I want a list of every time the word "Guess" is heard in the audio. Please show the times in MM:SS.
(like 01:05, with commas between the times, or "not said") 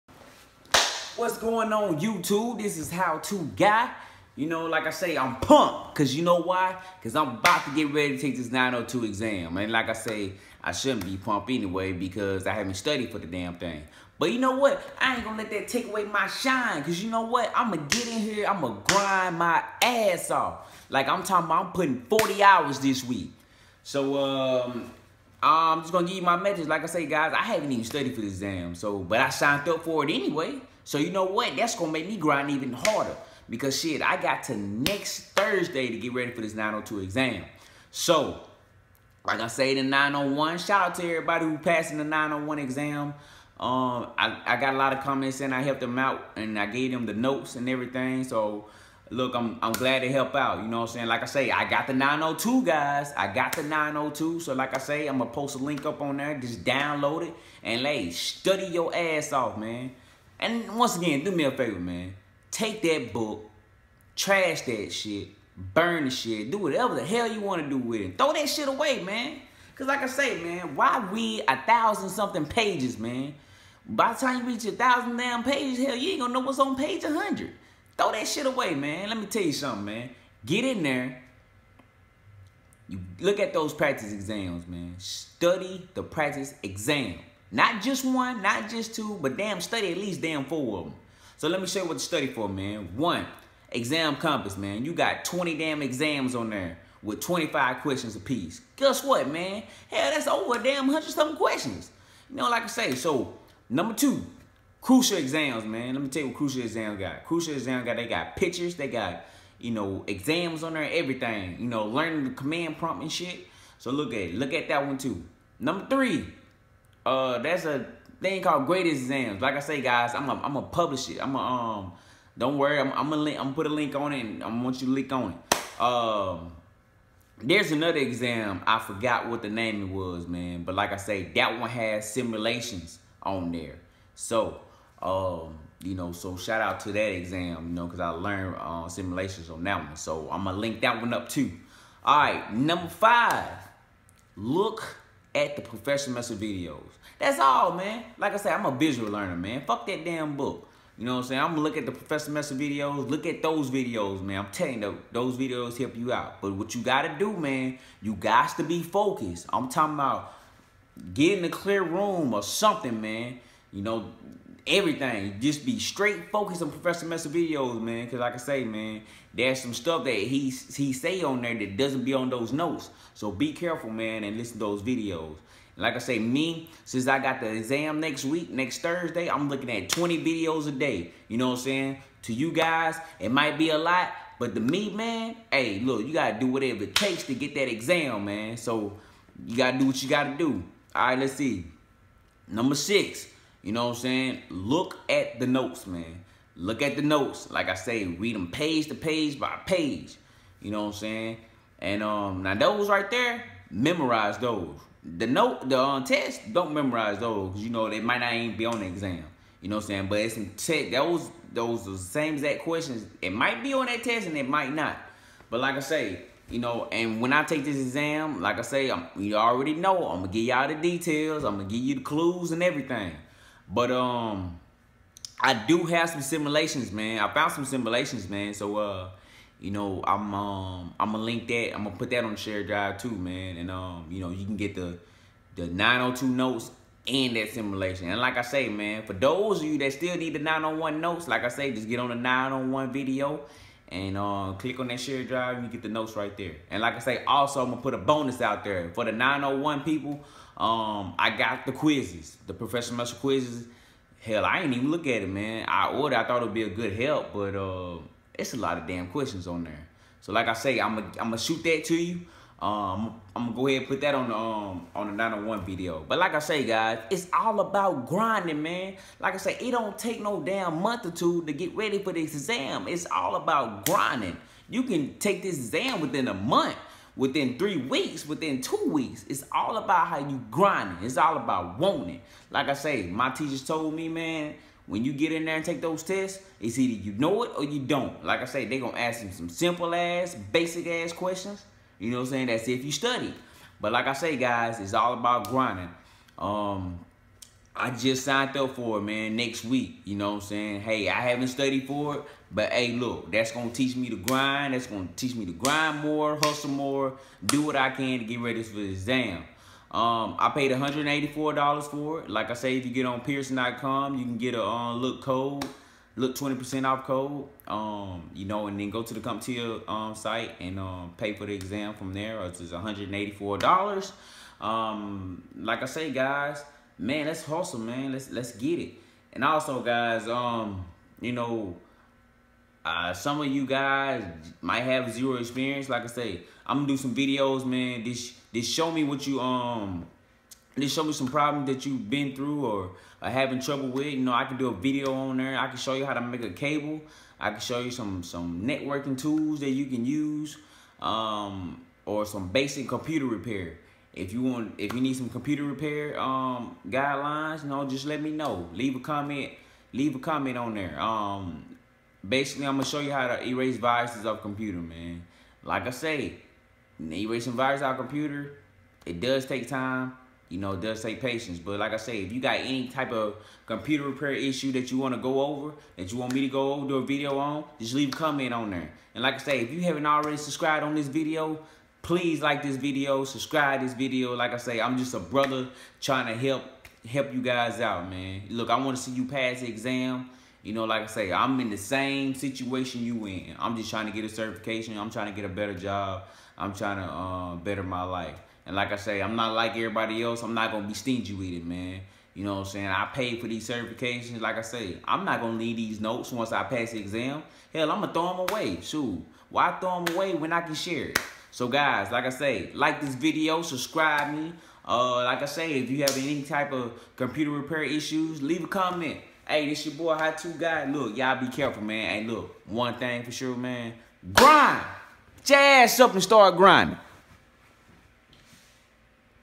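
01:38.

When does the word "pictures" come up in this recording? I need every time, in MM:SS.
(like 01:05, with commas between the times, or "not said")
01:48.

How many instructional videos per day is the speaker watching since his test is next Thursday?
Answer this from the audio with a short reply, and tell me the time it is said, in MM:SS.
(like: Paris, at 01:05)
20, at 02:59.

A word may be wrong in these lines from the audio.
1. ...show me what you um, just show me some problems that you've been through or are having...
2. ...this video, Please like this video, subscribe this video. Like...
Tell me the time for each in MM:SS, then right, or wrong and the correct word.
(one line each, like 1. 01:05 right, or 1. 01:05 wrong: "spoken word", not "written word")
1. 05:38 right
2. 06:20 right.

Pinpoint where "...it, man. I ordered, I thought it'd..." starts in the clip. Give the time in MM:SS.
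04:15.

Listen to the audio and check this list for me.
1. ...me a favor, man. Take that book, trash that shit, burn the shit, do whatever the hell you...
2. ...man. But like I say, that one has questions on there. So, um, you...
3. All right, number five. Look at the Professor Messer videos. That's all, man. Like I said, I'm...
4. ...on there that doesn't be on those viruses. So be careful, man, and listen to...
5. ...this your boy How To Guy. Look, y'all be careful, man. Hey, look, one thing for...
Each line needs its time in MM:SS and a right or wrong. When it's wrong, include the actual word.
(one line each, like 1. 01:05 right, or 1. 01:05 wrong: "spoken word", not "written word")
1. 01:01 right
2. 02:10 wrong: "simulations", not "questions"
3. 02:22 right
4. 02:51 wrong: "notes", not "viruses"
5. 06:59 right.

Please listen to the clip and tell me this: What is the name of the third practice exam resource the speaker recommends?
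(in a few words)
Gratis Exam.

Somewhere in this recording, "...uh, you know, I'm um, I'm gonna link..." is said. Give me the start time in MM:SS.
03:48.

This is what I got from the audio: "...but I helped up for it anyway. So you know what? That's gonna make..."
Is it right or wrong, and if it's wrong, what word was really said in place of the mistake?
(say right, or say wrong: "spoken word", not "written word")
wrong: "signed", not "helped".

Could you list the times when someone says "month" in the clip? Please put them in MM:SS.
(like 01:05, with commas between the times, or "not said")
04:30, 04:36.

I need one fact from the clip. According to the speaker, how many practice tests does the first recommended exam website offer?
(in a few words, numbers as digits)
20.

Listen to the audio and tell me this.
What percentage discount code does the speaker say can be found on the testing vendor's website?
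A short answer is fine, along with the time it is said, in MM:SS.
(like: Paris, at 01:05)
20%, at 05:16.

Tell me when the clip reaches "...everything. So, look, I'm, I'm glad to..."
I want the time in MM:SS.
00:47.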